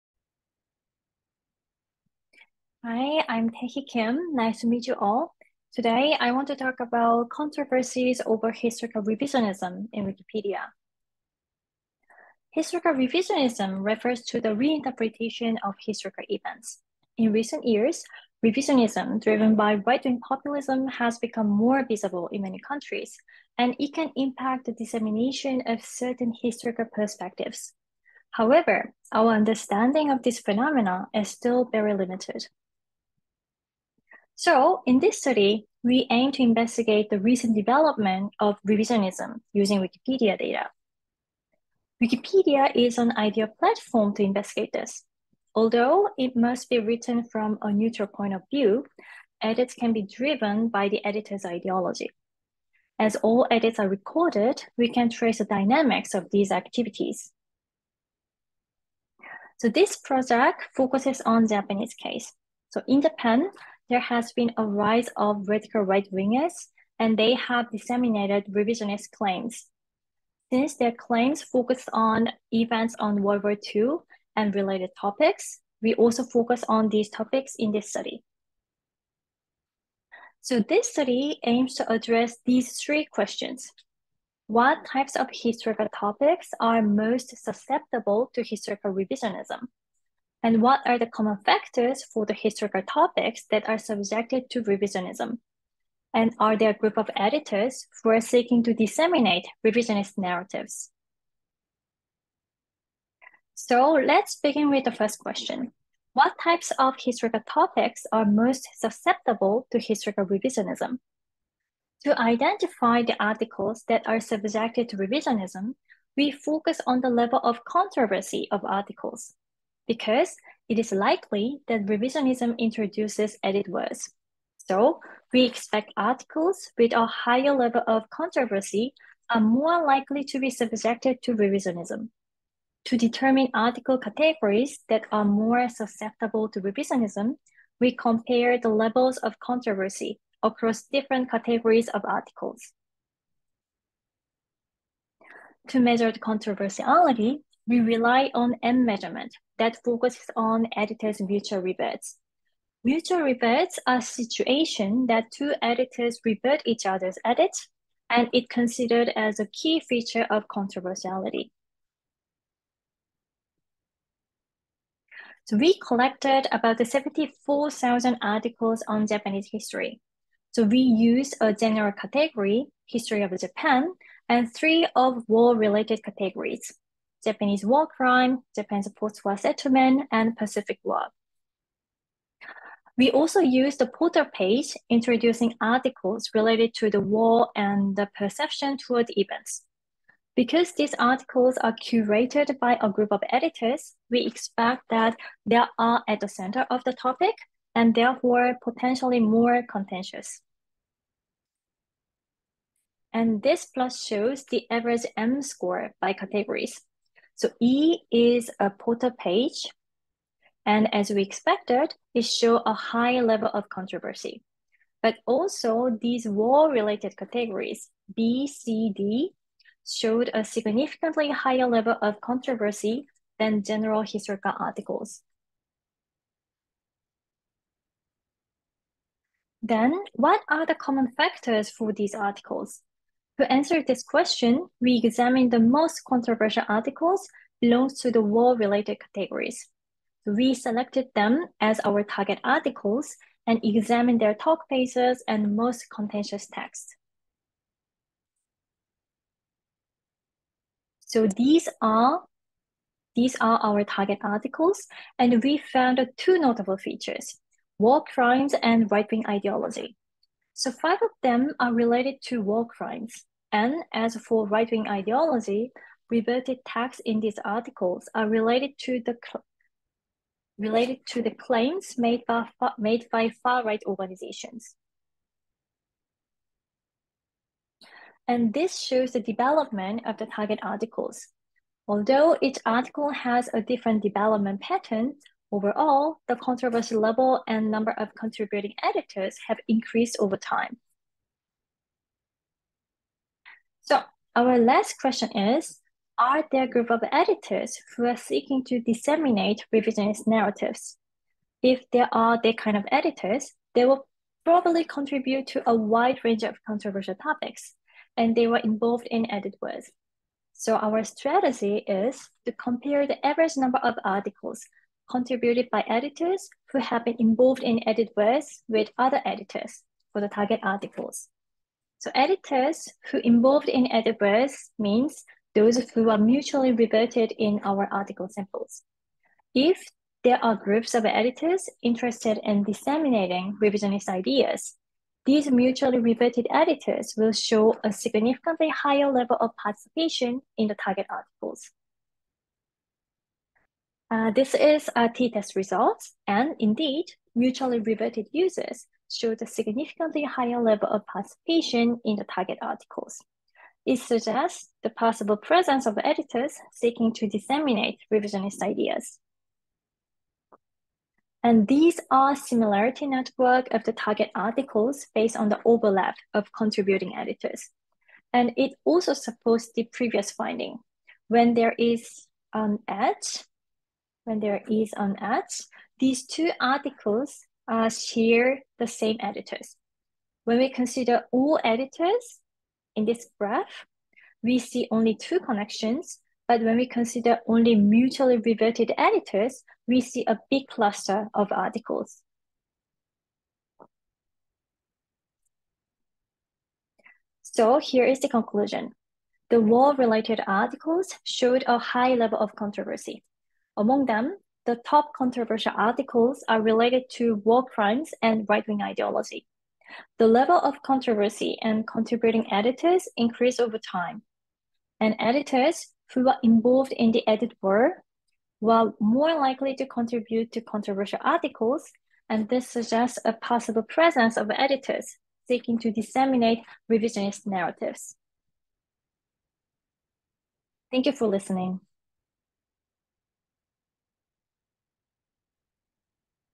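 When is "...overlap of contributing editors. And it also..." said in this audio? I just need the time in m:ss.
6:05.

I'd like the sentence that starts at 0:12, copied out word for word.
Historical revisionism refers to the reinterpretation of historical events.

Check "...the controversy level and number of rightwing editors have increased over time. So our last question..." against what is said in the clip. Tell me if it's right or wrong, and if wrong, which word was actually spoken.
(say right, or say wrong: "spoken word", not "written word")
wrong: "contributing", not "rightwing".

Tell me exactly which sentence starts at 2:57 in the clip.
Japanese war crime, Japan's post-war settlement, and Pacific War.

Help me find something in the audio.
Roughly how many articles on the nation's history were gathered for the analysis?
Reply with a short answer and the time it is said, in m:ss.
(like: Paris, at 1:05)
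74,000, at 2:46.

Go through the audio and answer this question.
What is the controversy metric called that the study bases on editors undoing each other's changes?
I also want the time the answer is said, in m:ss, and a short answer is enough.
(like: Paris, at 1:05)
M measurement, at 2:28.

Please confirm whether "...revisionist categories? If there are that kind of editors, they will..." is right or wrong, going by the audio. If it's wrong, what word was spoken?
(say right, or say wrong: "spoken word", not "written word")
wrong: "narratives", not "categories".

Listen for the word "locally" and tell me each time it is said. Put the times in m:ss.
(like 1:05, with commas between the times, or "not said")
not said.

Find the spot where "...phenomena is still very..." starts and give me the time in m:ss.
0:30.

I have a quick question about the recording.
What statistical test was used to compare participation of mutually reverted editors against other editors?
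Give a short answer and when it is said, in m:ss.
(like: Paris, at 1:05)
t-test, at 5:45.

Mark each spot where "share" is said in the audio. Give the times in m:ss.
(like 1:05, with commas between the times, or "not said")
6:17.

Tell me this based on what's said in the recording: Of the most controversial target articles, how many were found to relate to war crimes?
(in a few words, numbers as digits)
5.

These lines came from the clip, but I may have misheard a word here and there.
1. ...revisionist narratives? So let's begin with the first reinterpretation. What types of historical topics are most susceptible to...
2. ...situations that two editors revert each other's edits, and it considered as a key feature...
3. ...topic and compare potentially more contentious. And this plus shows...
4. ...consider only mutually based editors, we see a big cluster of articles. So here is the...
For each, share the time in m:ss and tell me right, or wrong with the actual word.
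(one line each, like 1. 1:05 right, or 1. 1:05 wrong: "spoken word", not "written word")
1. 1:39 wrong: "question", not "reinterpretation"
2. 2:34 right
3. 3:16 wrong: "therefore", not "compare"
4. 6:26 wrong: "reverted", not "based".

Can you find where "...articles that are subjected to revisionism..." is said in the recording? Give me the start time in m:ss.
1:53.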